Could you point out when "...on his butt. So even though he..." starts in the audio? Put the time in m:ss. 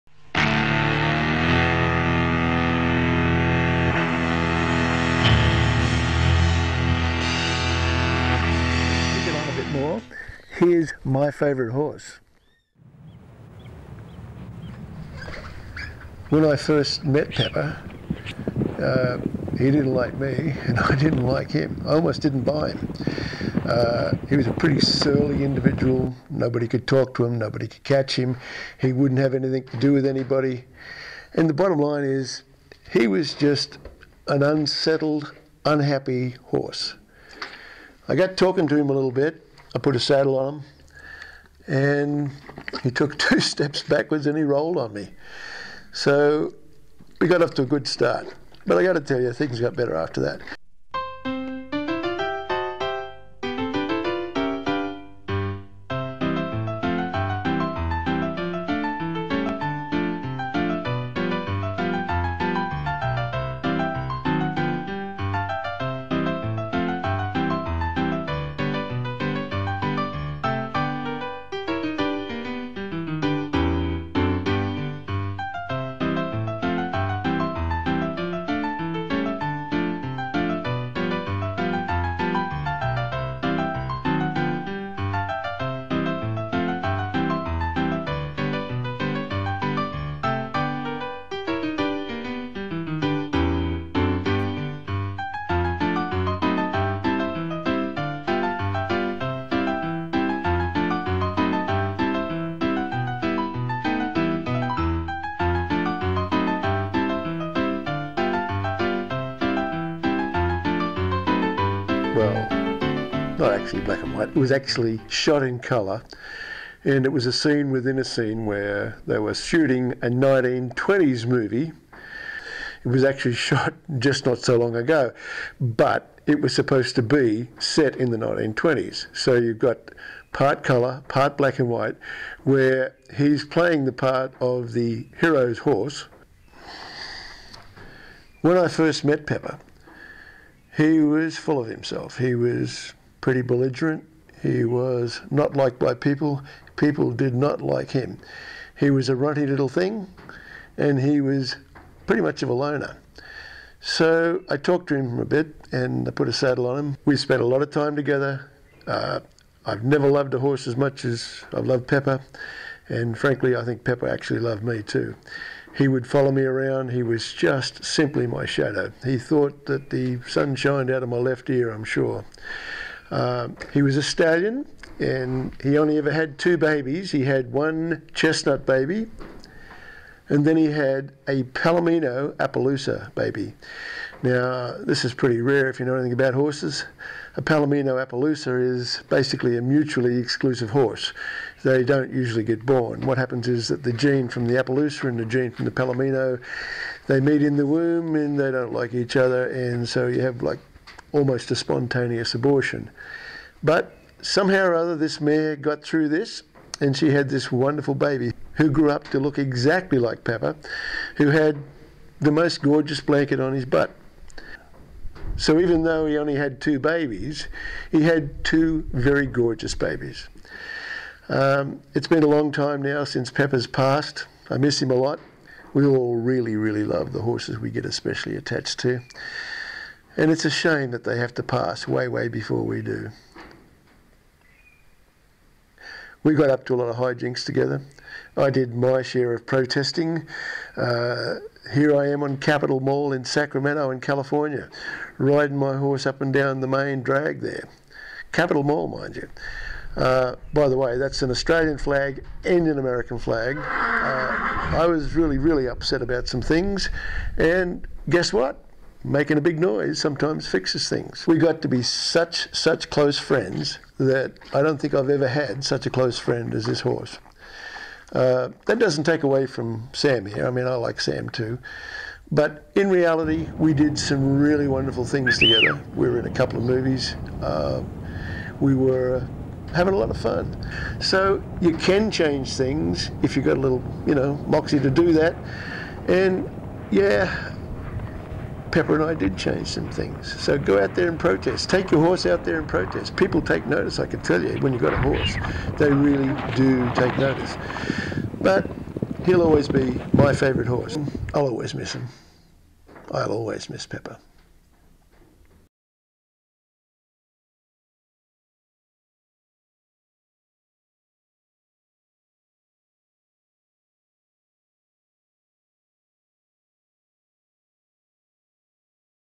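3:33.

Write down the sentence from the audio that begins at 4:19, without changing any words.
Making a big noise sometimes fixes things.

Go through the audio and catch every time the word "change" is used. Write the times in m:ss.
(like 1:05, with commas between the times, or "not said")
4:42, 4:49.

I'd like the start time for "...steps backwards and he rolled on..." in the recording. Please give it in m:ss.
0:43.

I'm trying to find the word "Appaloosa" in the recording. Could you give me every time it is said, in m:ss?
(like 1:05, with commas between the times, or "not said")
3:02, 3:08, 3:14.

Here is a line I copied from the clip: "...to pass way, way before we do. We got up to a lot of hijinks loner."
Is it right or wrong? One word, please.
wrong.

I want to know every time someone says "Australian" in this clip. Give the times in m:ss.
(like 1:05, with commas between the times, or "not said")
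4:11.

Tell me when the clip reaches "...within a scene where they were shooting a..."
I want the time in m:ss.
1:57.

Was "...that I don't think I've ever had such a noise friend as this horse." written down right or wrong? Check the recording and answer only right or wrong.
wrong.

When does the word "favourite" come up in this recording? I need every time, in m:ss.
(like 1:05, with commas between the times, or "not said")
0:11, 5:00.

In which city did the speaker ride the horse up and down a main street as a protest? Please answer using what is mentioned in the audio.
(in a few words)
Sacramento.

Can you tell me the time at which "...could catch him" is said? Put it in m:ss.
0:27.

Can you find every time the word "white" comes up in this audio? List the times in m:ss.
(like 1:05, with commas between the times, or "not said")
1:54, 2:11.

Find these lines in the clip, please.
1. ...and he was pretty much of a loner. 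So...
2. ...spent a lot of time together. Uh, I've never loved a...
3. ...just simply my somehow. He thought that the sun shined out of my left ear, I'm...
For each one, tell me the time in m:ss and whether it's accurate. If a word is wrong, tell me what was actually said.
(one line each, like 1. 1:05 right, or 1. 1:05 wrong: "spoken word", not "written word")
1. 2:30 right
2. 2:37 right
3. 2:47 wrong: "shadow", not "somehow".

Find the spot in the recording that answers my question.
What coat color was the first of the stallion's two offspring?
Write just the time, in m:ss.
2:58.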